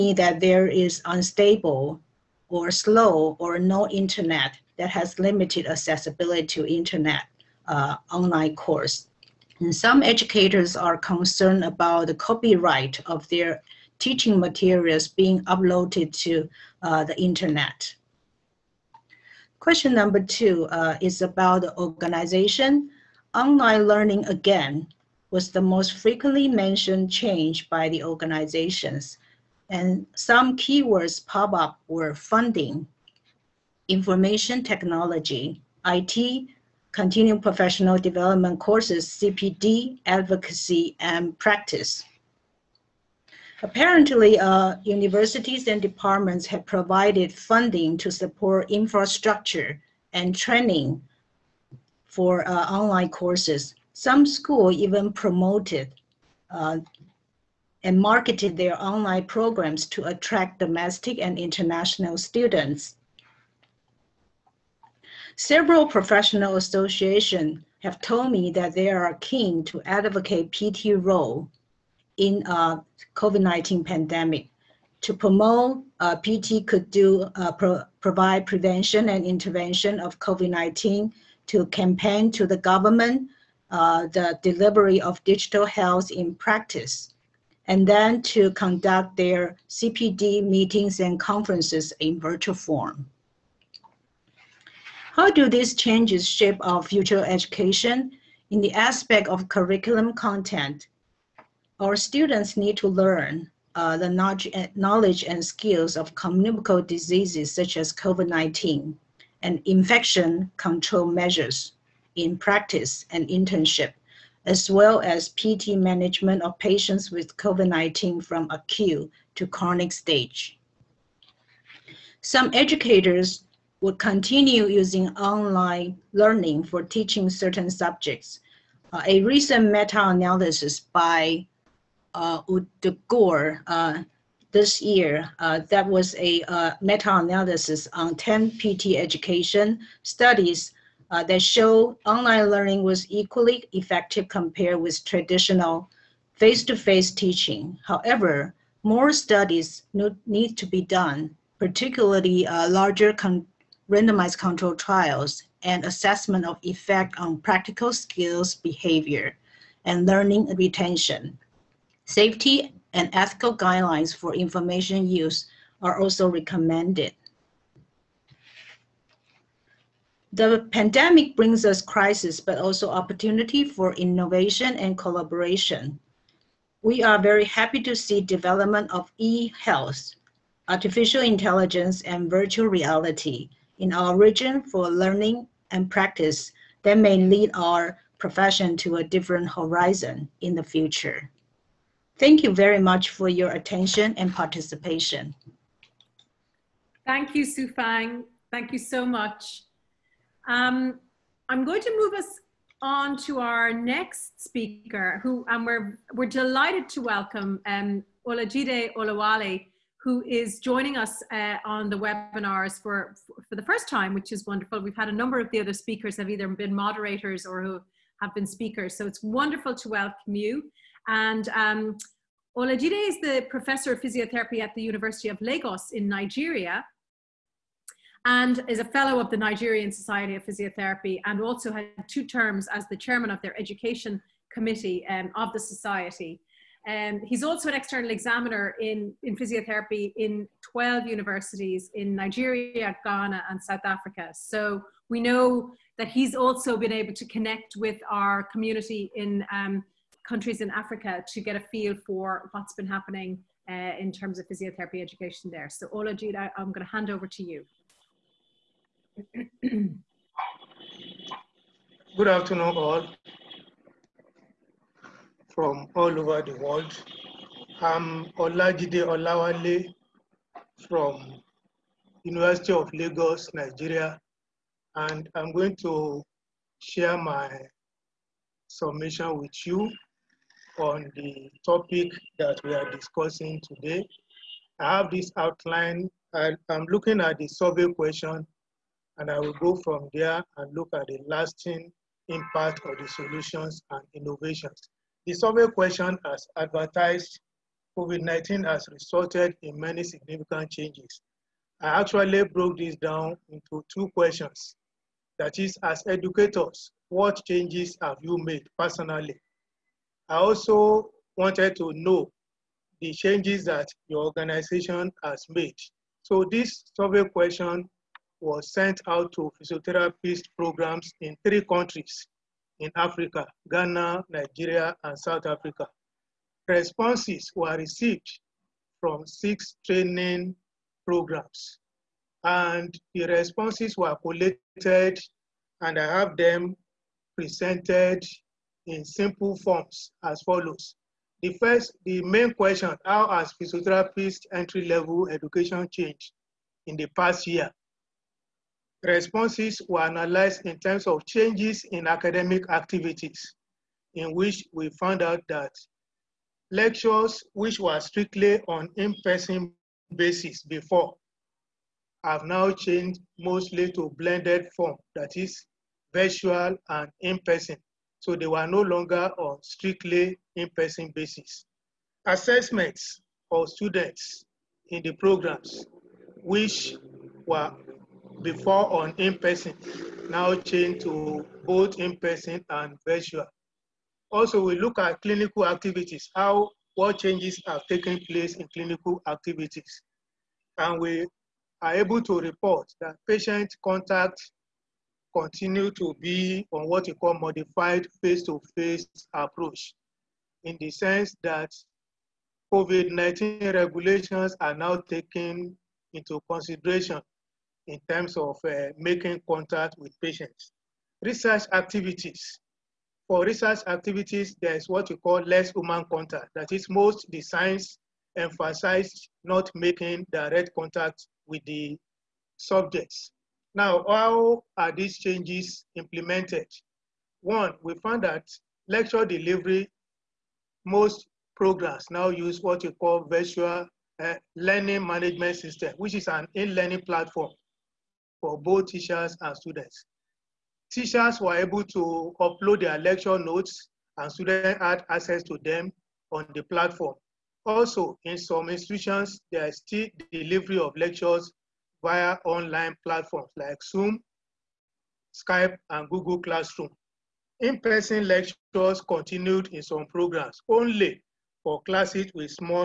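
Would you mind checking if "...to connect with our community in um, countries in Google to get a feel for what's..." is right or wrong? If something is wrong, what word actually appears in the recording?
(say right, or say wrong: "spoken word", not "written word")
wrong: "Africa", not "Google".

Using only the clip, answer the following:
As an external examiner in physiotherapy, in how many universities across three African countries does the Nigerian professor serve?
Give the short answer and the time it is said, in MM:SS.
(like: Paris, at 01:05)
12, at 04:00.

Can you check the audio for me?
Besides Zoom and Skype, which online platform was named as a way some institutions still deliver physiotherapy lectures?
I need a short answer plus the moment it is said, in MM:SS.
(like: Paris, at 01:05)
Google Classroom, at 07:36.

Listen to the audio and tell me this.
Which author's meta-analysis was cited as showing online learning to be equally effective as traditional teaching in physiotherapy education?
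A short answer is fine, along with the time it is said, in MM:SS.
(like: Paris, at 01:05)
Gore, at 02:13.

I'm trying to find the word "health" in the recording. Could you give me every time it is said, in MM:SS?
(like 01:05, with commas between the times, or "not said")
01:25, 02:59.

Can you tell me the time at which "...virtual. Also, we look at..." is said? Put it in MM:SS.
06:23.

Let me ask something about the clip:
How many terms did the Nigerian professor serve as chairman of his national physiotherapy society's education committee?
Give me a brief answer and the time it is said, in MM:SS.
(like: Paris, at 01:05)
2, at 03:52.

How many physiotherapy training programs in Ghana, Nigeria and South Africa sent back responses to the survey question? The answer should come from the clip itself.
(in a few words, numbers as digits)
6.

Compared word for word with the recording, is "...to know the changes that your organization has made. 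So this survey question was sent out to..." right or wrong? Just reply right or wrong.
right.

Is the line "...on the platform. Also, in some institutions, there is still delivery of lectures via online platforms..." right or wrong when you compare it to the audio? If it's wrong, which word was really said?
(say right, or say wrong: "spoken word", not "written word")
right.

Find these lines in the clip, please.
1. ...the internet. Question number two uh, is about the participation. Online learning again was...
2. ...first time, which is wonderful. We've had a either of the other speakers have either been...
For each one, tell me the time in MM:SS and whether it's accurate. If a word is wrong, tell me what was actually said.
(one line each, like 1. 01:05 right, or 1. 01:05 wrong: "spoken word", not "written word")
1. 00:17 wrong: "organization", not "participation"
2. 03:33 wrong: "number", not "either".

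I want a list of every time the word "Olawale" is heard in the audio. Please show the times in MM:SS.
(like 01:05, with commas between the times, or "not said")
03:28, 04:29.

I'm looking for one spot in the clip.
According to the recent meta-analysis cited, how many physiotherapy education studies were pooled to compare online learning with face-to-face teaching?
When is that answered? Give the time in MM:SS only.
02:18.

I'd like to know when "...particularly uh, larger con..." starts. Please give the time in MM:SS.
02:31.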